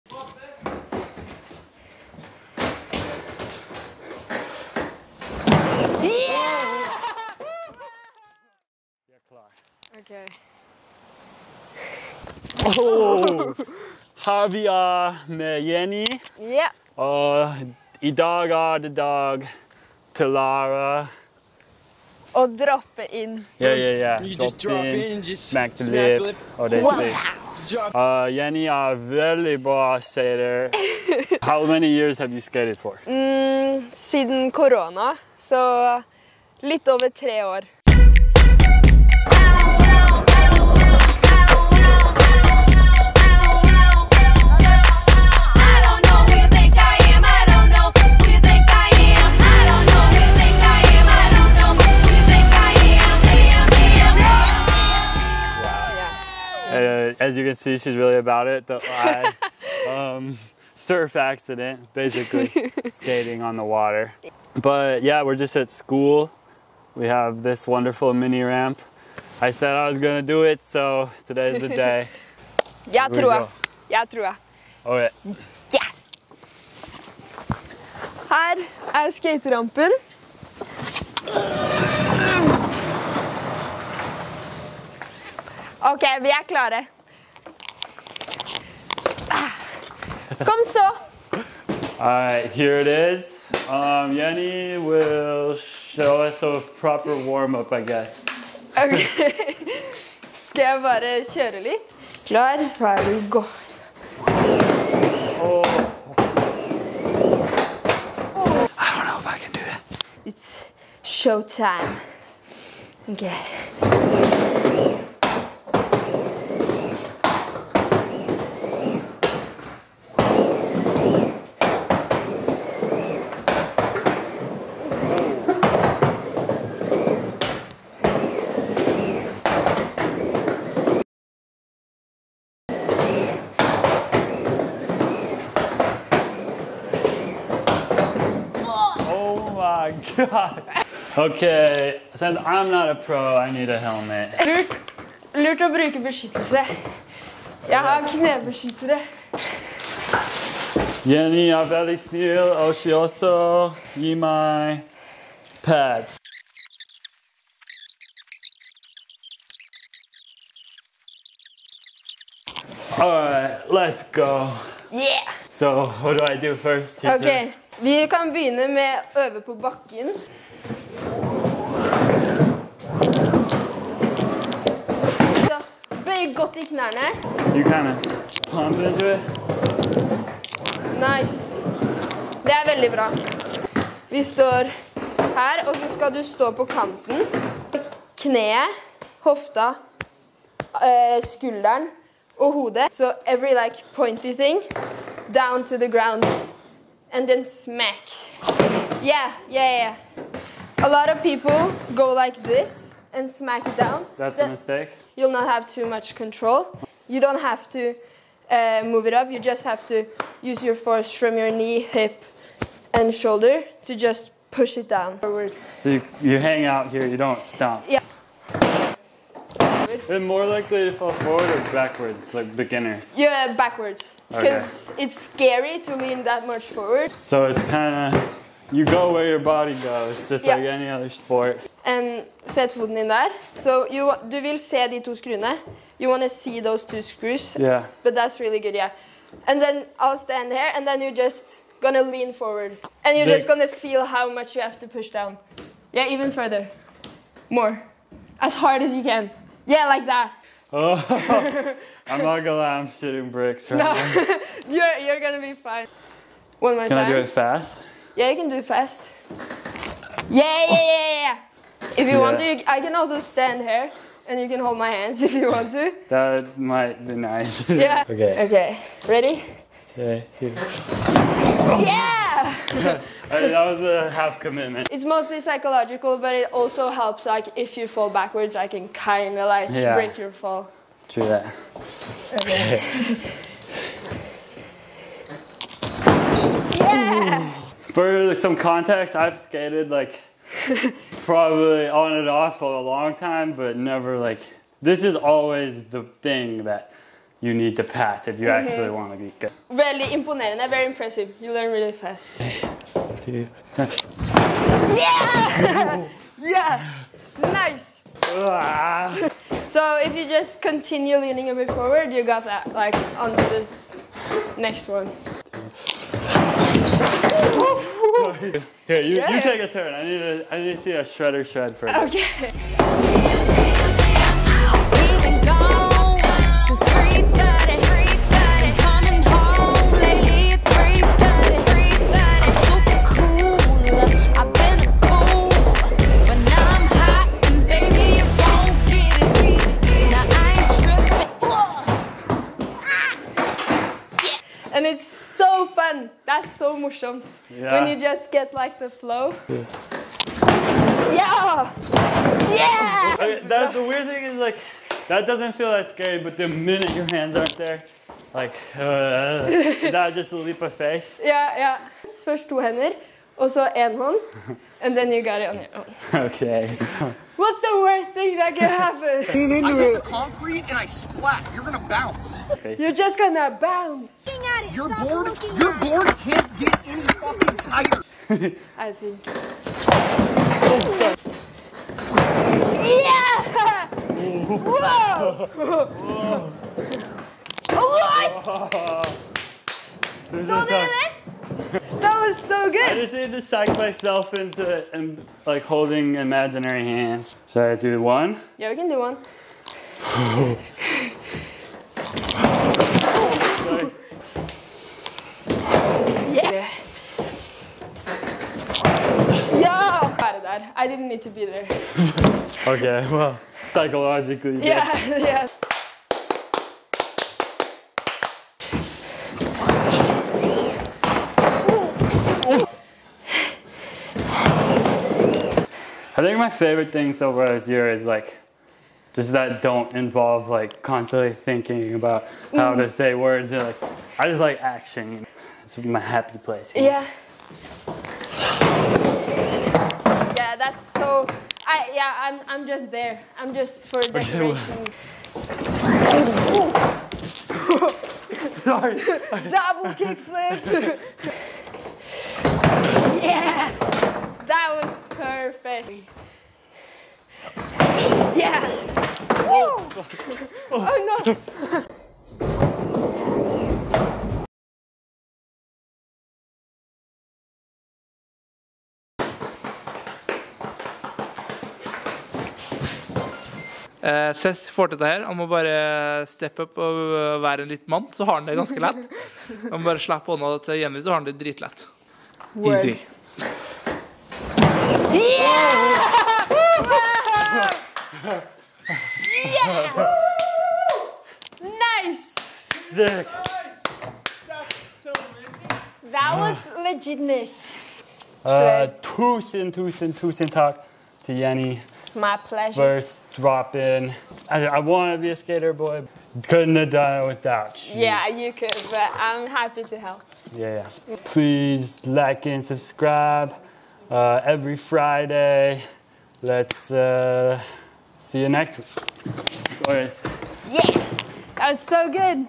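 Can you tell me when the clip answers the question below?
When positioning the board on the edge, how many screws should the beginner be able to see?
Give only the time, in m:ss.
3:56.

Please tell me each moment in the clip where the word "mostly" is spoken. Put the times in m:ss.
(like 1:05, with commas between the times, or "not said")
4:35.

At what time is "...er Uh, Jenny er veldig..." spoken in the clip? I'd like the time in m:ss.
0:26.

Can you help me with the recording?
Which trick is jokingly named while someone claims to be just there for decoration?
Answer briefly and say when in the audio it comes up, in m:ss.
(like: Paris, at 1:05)
Double kickflip, at 7:29.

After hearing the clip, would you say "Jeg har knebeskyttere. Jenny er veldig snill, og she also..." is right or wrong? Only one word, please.
right.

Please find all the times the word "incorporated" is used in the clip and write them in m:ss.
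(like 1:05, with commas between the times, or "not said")
not said.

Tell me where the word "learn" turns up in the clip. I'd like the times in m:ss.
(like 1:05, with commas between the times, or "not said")
5:01.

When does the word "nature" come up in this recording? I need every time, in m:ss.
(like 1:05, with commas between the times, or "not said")
not said.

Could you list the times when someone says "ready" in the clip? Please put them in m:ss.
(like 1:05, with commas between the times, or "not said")
1:42, 4:29.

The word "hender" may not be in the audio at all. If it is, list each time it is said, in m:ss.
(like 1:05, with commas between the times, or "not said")
6:02.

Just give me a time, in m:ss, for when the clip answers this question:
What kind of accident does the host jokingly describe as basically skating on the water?
1:00.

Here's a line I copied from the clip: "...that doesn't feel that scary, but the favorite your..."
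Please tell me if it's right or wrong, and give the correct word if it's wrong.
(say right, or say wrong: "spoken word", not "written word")
wrong: "minute", not "favorite".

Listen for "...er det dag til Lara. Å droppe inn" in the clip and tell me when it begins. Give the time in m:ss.
0:18.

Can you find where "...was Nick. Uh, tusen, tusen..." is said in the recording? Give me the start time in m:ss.
8:16.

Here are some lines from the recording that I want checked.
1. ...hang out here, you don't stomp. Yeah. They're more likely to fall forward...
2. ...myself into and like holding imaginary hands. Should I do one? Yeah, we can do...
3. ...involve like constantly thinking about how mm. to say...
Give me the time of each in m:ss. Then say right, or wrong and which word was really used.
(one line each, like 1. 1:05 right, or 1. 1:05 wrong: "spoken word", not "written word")
1. 3:36 right
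2. 6:33 right
3. 7:09 right.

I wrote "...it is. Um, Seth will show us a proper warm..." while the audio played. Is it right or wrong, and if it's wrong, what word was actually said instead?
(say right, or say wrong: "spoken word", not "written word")
wrong: "Yanni", not "Seth".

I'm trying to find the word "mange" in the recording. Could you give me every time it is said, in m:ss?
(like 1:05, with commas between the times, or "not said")
0:31.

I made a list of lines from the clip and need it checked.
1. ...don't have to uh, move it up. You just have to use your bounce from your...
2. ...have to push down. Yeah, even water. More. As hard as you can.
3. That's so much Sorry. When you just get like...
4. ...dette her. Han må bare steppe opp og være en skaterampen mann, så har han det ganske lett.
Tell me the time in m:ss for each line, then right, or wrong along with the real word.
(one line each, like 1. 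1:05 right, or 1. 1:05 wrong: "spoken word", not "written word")
1. 3:27 wrong: "force", not "bounce"
2. 4:04 wrong: "further", not "water"
3. 5:46 wrong: "Yeah", not "Sorry"
4. 7:54 wrong: "liten", not "skaterampen".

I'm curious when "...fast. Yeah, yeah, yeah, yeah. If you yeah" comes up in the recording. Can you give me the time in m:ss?
4:18.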